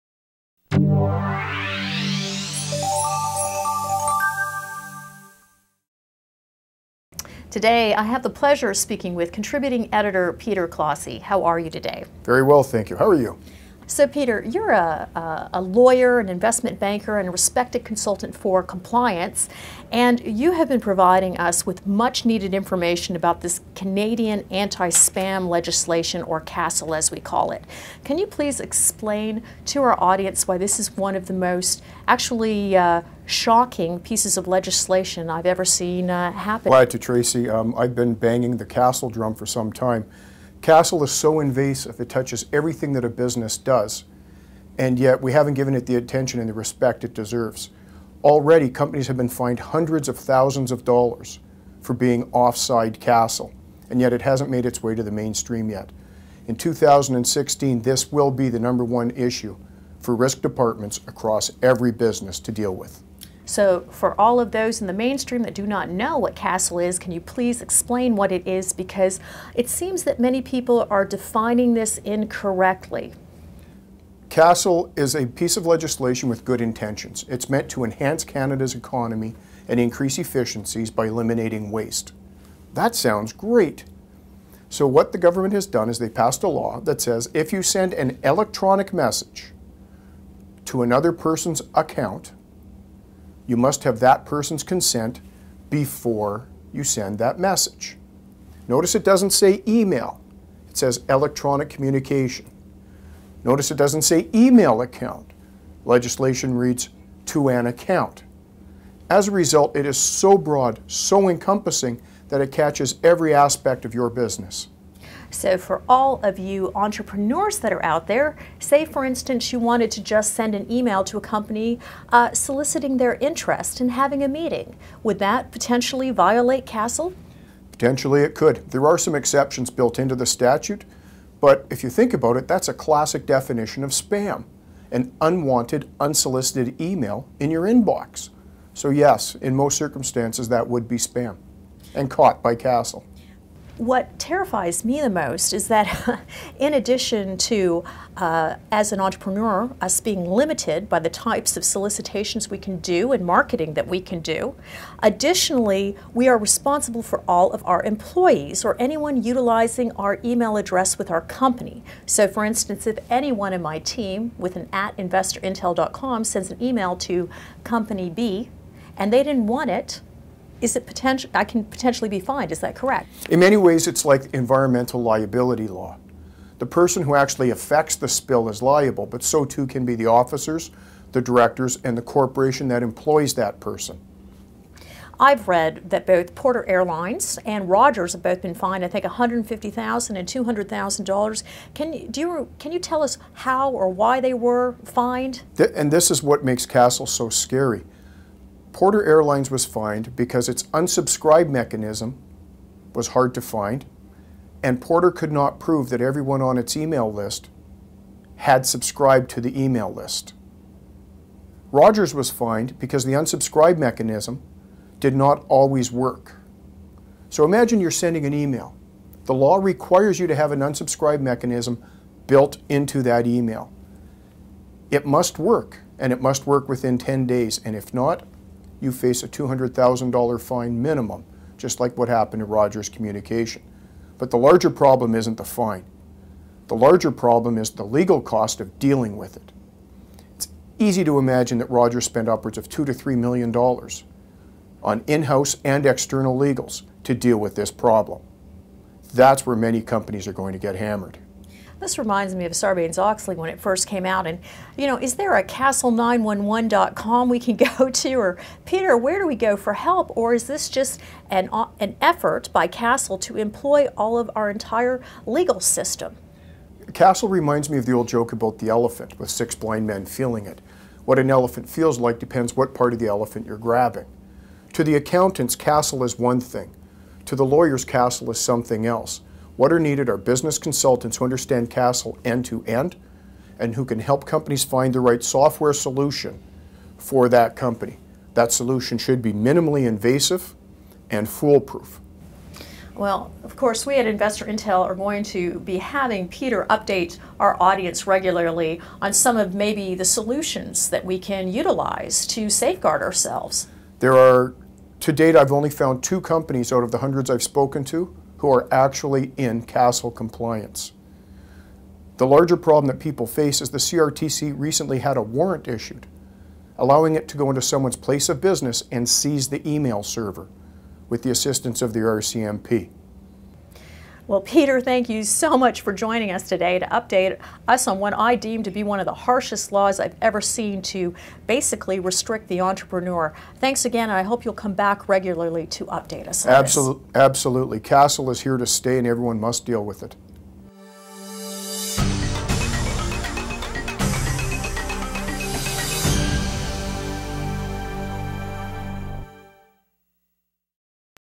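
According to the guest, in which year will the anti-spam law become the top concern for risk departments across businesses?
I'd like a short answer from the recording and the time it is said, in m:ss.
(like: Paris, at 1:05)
2016, at 0:56.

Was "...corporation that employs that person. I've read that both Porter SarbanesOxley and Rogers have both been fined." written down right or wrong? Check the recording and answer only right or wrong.
wrong.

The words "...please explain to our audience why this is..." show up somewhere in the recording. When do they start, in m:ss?
0:28.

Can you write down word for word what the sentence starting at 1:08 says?
Because it seems that many people are defining this incorrectly.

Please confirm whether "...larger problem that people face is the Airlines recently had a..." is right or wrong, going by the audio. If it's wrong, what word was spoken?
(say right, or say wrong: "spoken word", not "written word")
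wrong: "CRTC", not "Airlines".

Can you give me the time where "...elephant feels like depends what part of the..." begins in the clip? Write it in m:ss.
4:31.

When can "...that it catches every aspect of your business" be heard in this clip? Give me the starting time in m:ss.
1:52.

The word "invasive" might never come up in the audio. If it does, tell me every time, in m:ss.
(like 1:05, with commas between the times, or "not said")
0:41, 4:49.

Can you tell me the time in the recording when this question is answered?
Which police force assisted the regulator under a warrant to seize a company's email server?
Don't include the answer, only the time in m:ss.
5:21.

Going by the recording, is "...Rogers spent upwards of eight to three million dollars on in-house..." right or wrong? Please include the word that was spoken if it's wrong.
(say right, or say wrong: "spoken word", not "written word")
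wrong: "two", not "eight".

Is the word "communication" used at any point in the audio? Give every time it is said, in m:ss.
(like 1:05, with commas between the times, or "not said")
1:41, 3:52.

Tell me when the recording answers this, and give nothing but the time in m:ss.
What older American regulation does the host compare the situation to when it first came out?
4:12.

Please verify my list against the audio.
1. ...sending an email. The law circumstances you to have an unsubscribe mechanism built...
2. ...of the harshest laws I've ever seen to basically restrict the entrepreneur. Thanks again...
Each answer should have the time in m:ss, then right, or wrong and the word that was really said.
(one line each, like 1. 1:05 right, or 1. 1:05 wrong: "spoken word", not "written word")
1. 3:37 wrong: "requires", not "circumstances"
2. 5:29 right.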